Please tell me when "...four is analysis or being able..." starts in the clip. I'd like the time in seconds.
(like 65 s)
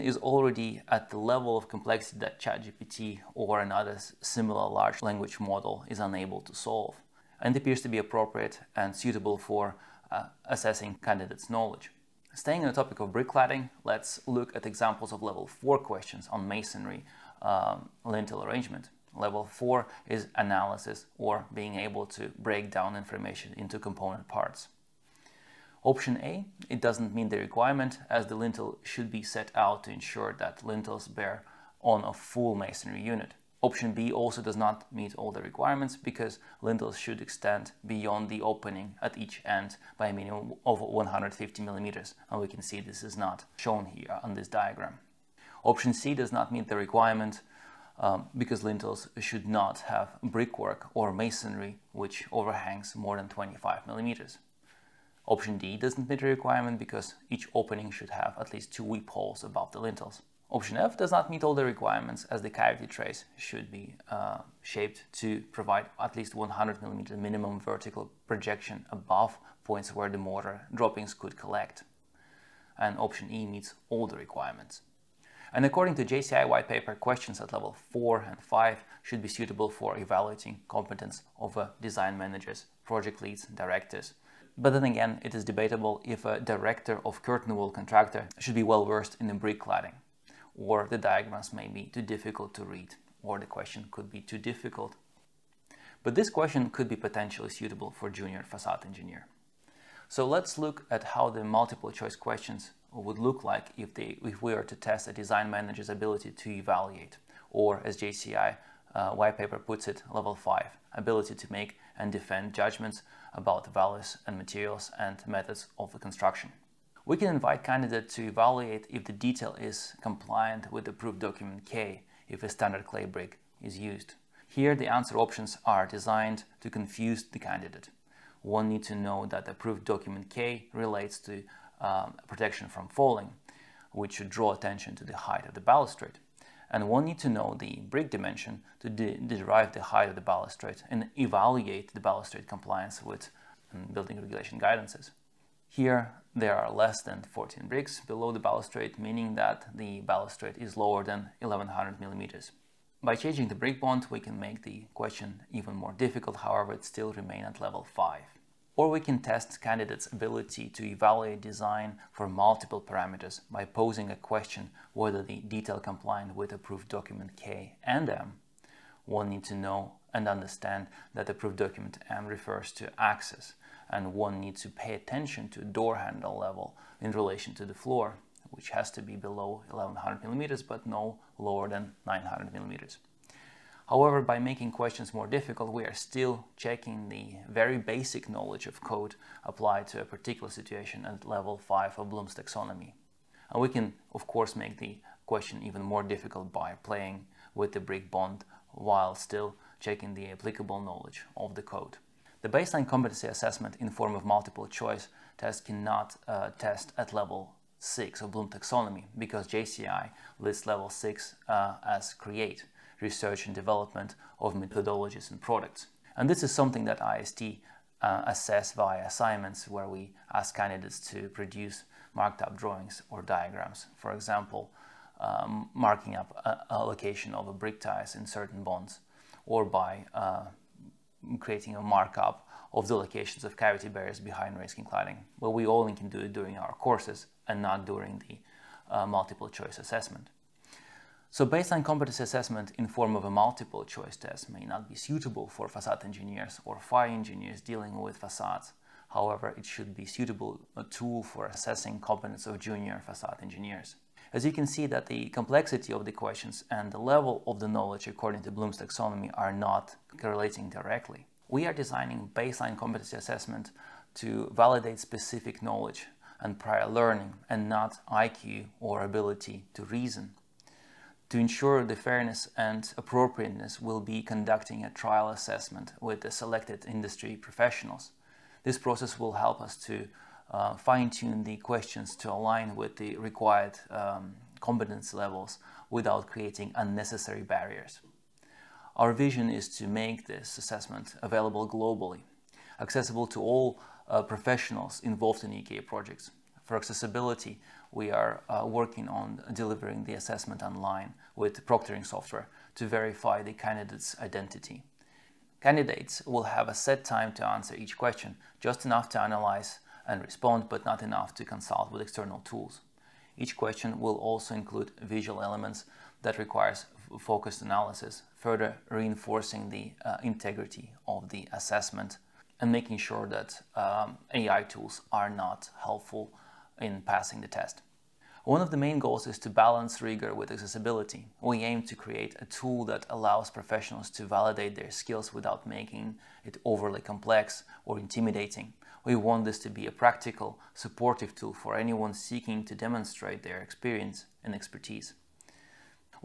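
19 s.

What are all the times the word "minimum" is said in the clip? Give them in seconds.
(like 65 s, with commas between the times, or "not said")
40 s, 67 s.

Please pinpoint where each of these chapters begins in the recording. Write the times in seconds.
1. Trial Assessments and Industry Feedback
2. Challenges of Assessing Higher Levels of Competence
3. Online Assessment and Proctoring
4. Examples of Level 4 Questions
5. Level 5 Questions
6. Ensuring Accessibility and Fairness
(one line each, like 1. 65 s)
1. 256 s
2. 190 s
3. 291 s
4. 29 s
5. 92 s
6. 327 s.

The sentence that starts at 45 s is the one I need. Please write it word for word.
Option C does not meet the requirement um, because lintels should not have brickwork or masonry which overhangs more than 25 millimeters.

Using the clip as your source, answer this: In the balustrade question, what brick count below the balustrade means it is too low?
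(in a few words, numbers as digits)
14.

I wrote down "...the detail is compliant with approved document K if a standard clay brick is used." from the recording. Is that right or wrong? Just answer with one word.
right.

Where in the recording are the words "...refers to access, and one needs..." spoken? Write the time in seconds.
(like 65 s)
172 s.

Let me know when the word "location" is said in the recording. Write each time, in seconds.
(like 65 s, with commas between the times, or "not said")
226 s, 232 s.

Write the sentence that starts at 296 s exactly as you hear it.
For accessibility, we are uh, working on delivering the assessment online with proctoring software to verify the candidate's identity.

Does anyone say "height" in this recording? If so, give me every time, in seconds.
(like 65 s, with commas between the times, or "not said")
135 s, 139 s.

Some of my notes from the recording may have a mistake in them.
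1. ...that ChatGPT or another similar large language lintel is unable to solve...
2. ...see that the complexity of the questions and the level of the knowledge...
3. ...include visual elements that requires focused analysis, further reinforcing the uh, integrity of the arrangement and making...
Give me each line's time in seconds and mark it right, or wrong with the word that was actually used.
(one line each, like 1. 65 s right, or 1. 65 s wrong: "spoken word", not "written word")
1. 2 s wrong: "model", not "lintel"
2. 254 s right
3. 314 s wrong: "assessment", not "arrangement".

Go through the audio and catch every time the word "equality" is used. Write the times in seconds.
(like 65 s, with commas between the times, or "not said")
not said.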